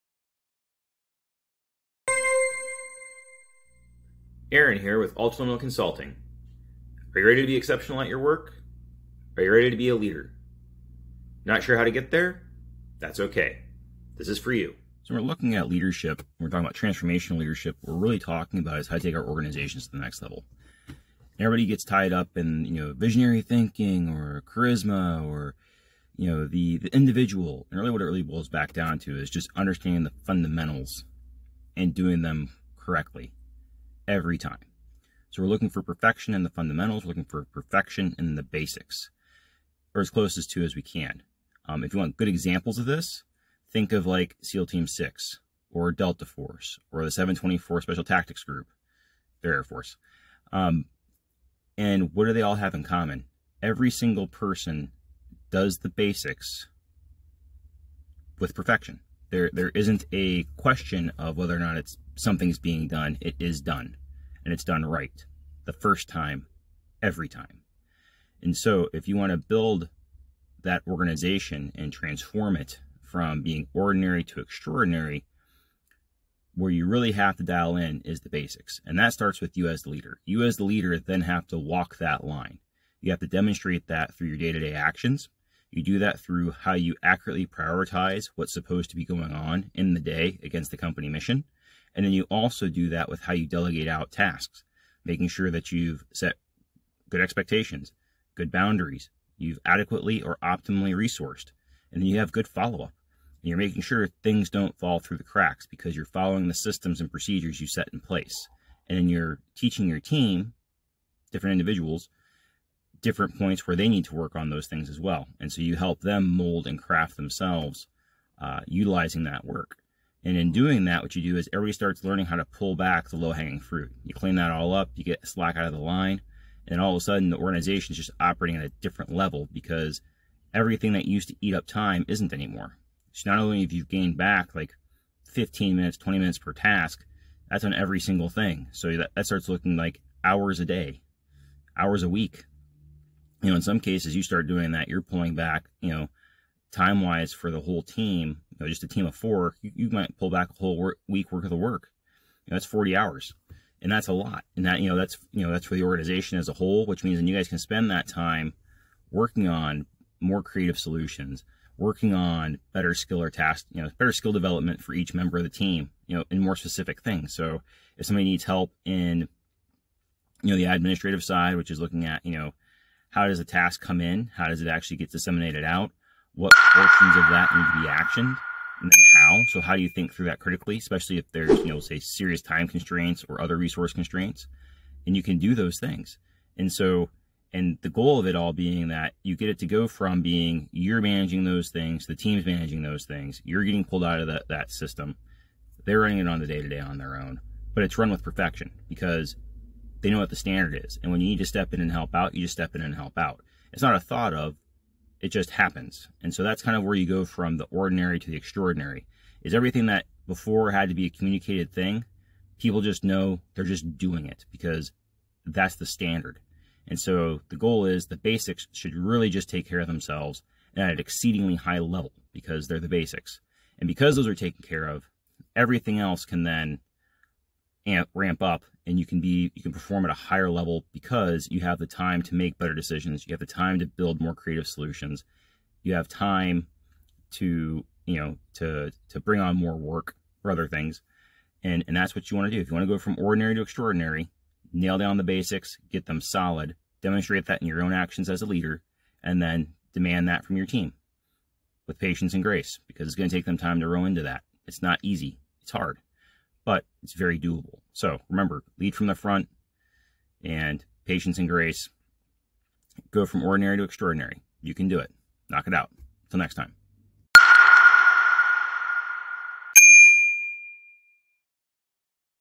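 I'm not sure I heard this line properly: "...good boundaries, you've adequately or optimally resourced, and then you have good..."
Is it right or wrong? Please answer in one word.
right.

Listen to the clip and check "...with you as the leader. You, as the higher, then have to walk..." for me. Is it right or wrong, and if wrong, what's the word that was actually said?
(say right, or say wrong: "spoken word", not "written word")
wrong: "leader", not "higher".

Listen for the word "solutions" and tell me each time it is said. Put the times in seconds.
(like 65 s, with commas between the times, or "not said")
160 s, 234 s.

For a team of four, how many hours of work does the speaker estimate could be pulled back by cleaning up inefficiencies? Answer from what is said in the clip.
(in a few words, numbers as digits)
40.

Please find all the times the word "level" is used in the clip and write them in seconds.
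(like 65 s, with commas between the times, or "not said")
20 s, 129 s, 221 s, 230 s.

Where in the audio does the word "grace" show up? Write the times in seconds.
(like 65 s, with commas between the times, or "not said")
252 s, 261 s.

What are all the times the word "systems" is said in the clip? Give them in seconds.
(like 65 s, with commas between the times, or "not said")
106 s, 194 s.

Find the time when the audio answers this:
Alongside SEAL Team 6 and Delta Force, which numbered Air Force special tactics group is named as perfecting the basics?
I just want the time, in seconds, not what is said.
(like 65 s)
47 s.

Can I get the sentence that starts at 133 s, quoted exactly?
So not only have you gained back like 15 minutes, 20 minutes per task, that's on every single thing.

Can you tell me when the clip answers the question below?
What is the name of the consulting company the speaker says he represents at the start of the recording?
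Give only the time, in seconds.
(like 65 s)
5 s.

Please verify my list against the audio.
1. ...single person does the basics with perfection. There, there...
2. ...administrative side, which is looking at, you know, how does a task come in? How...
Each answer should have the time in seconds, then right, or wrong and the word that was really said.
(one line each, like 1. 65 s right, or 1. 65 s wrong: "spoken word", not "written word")
1. 53 s right
2. 170 s right.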